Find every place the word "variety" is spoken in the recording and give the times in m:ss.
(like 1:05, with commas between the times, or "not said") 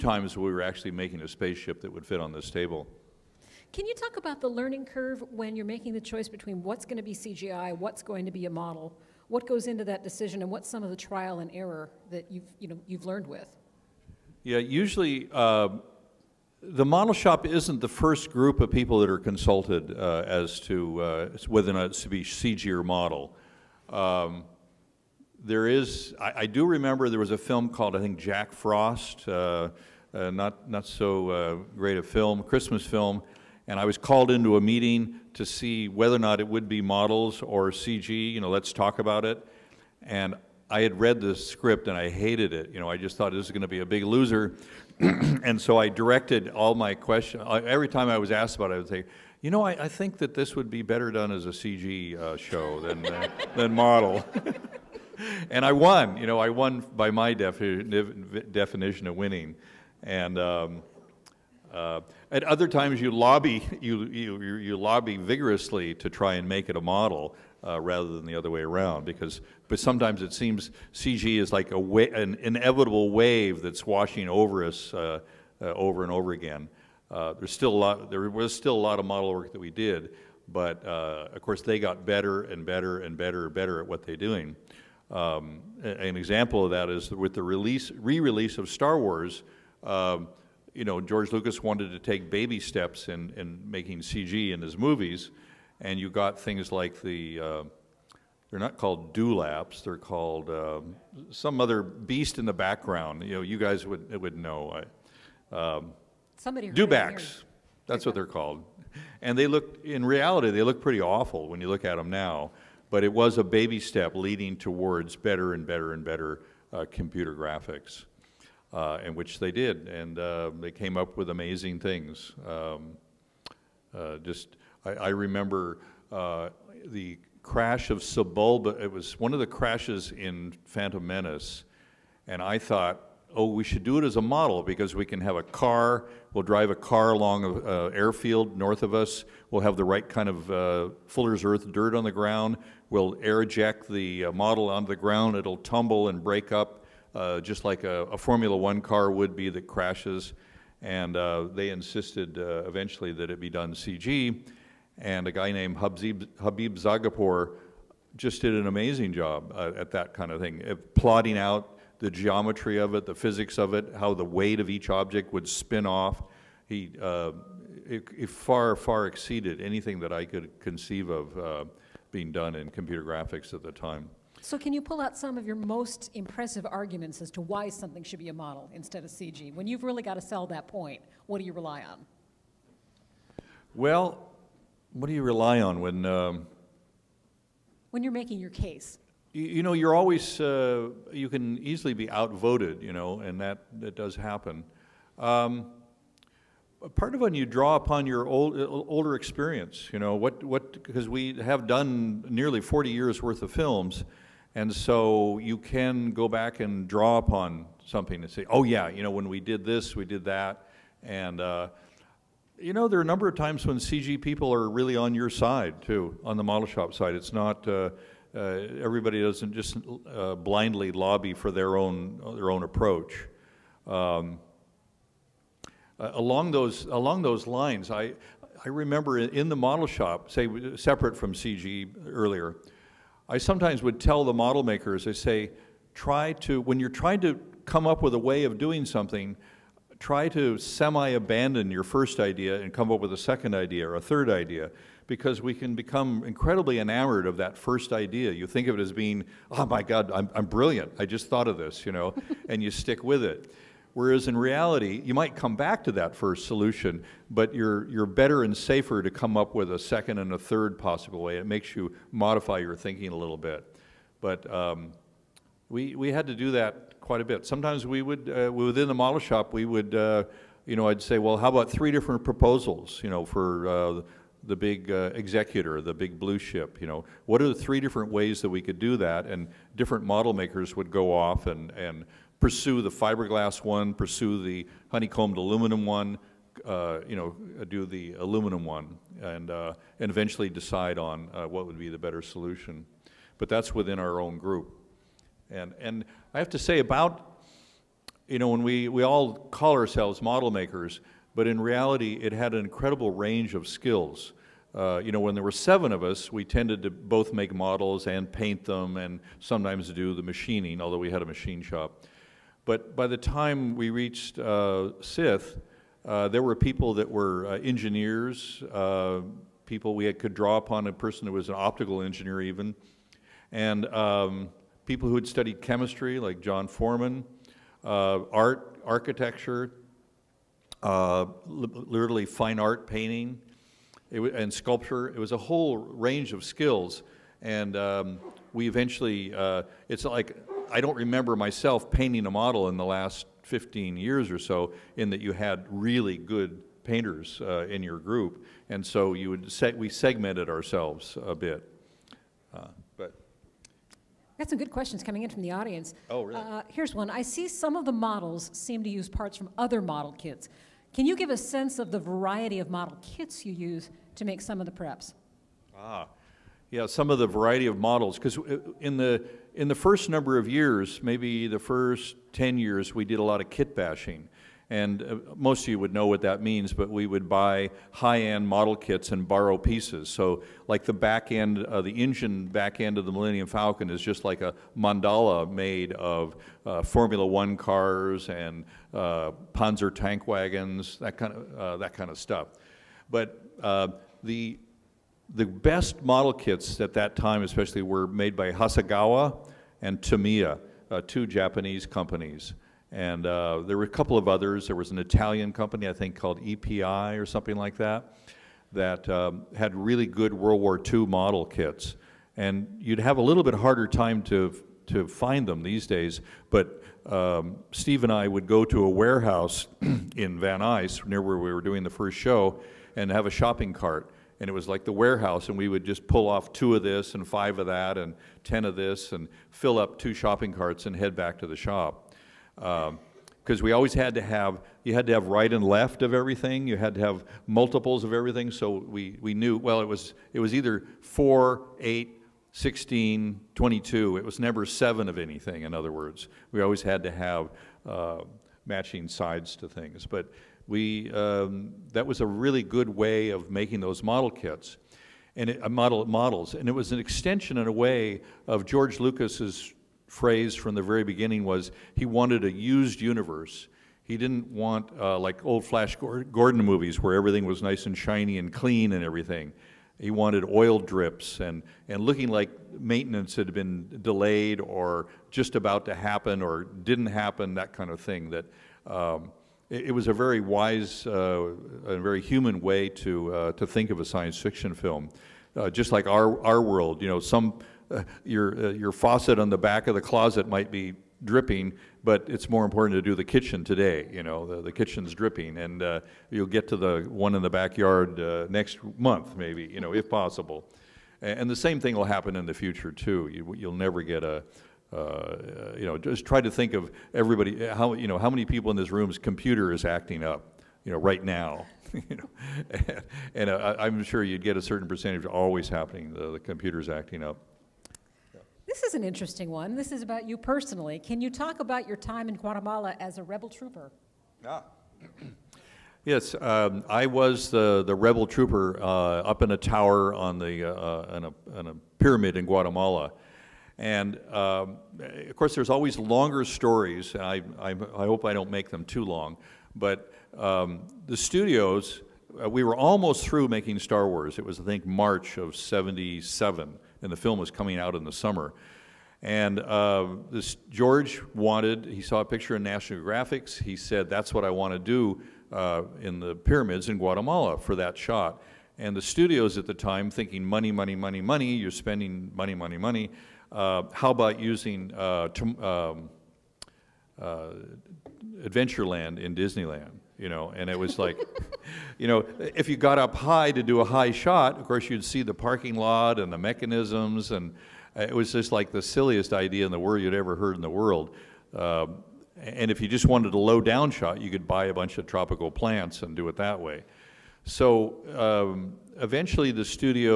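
6:01, 6:07.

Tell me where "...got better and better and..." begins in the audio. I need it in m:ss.
1:21.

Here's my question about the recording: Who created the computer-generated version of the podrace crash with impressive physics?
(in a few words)
Habib Zargarpour.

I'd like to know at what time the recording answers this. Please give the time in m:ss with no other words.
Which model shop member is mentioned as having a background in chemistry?
5:26.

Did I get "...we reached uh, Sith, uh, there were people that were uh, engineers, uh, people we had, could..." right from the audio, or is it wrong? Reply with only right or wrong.
right.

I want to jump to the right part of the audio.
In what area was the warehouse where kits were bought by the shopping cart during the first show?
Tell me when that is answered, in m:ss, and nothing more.
7:00.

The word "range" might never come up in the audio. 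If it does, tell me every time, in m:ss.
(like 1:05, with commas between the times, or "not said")
5:03, 5:35.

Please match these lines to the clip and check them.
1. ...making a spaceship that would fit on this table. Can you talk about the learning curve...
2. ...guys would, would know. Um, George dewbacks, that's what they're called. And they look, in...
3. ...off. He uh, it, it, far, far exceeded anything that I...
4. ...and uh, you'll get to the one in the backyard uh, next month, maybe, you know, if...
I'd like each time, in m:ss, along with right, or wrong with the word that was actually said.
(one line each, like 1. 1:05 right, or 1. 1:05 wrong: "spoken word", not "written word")
1. 0:00 right
2. 1:43 wrong: "Somebody", not "George"
3. 2:45 right
4. 8:15 right.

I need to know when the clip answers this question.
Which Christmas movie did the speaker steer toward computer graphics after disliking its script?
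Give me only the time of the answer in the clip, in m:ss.
0:28.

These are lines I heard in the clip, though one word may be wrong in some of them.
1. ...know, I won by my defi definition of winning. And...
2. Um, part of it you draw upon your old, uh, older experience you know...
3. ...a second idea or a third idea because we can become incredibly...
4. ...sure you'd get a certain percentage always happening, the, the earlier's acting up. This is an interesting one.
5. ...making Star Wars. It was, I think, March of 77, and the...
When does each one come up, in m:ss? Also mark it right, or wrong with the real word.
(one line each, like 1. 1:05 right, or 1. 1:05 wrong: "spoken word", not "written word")
1. 0:56 right
2. 3:15 right
3. 4:03 right
4. 8:34 wrong: "computer", not "earlier"
5. 9:03 right.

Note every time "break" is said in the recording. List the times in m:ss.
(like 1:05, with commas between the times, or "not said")
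2:26.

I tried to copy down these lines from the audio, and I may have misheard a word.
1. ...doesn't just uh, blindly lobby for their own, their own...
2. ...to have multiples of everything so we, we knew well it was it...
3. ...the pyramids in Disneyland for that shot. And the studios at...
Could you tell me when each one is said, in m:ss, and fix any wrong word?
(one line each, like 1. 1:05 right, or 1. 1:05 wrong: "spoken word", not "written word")
1. 3:39 right
2. 7:16 right
3. 9:16 wrong: "Guatemala", not "Disneyland".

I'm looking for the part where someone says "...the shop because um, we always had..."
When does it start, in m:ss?
7:11.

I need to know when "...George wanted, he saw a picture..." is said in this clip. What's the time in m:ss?
9:10.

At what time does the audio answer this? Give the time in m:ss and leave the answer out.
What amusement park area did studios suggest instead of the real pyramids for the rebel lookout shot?
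9:28.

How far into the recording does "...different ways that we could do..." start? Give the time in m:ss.
4:37.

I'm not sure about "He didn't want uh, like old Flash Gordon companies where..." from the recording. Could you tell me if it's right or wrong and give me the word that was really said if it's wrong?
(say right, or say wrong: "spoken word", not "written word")
wrong: "movies", not "companies".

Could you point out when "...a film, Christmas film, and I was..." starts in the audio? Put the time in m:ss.
0:31.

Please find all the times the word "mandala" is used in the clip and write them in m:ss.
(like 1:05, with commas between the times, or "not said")
6:24.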